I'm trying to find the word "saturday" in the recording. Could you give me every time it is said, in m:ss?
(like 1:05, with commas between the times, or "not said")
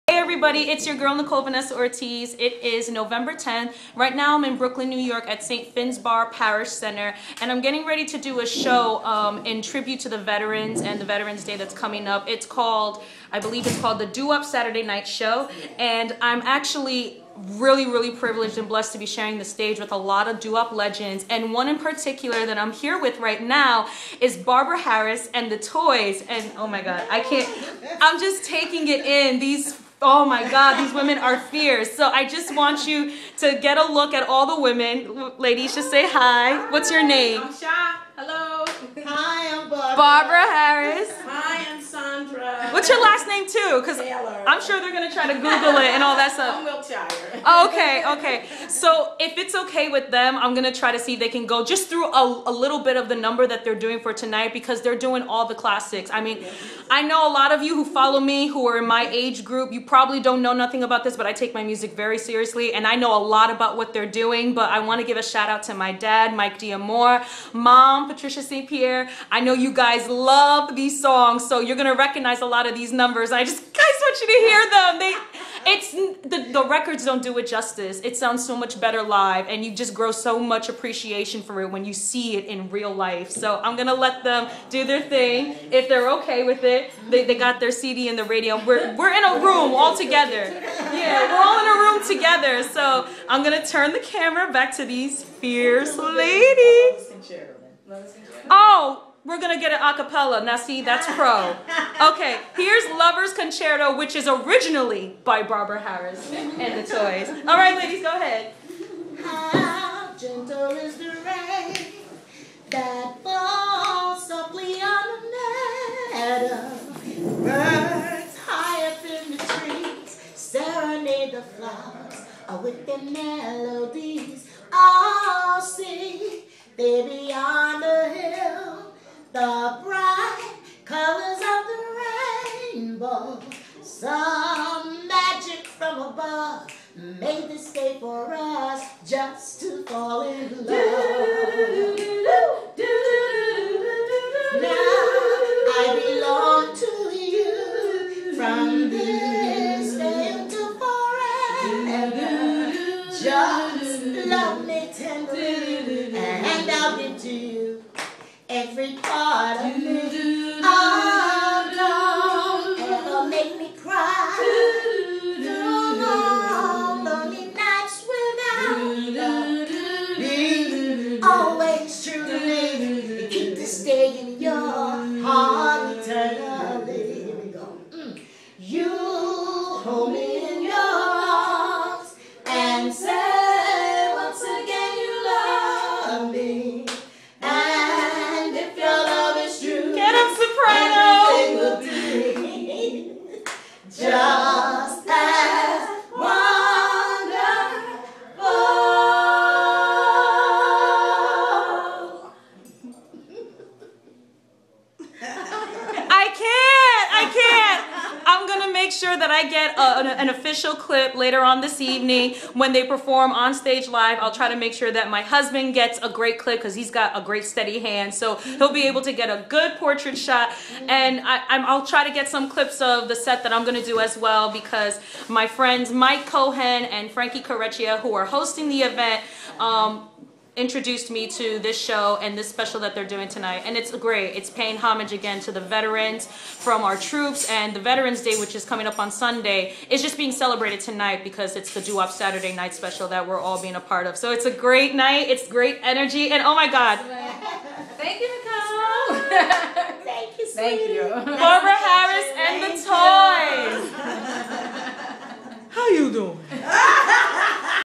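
0:14, 4:02.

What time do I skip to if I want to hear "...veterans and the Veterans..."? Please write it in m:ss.
0:10.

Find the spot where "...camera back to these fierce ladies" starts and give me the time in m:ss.
1:33.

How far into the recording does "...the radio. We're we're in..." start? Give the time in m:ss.
1:28.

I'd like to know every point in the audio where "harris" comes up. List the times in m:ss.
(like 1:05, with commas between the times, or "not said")
0:24, 0:40, 1:45, 4:11.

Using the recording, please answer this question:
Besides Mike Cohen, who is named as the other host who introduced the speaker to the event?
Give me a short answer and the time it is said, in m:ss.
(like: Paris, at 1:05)
Frankie Correcchia, at 3:47.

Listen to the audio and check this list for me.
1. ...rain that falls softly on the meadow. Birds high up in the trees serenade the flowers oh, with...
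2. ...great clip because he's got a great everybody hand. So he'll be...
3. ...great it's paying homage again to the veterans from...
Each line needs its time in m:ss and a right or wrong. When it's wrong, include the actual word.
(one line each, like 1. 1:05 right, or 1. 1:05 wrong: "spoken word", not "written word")
1. 1:51 right
2. 3:36 wrong: "steady", not "everybody"
3. 3:53 right.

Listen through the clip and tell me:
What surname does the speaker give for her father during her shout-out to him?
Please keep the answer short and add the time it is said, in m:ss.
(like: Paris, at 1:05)
Diamore, at 1:06.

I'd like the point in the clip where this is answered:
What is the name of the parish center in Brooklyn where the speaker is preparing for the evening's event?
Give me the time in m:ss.
0:05.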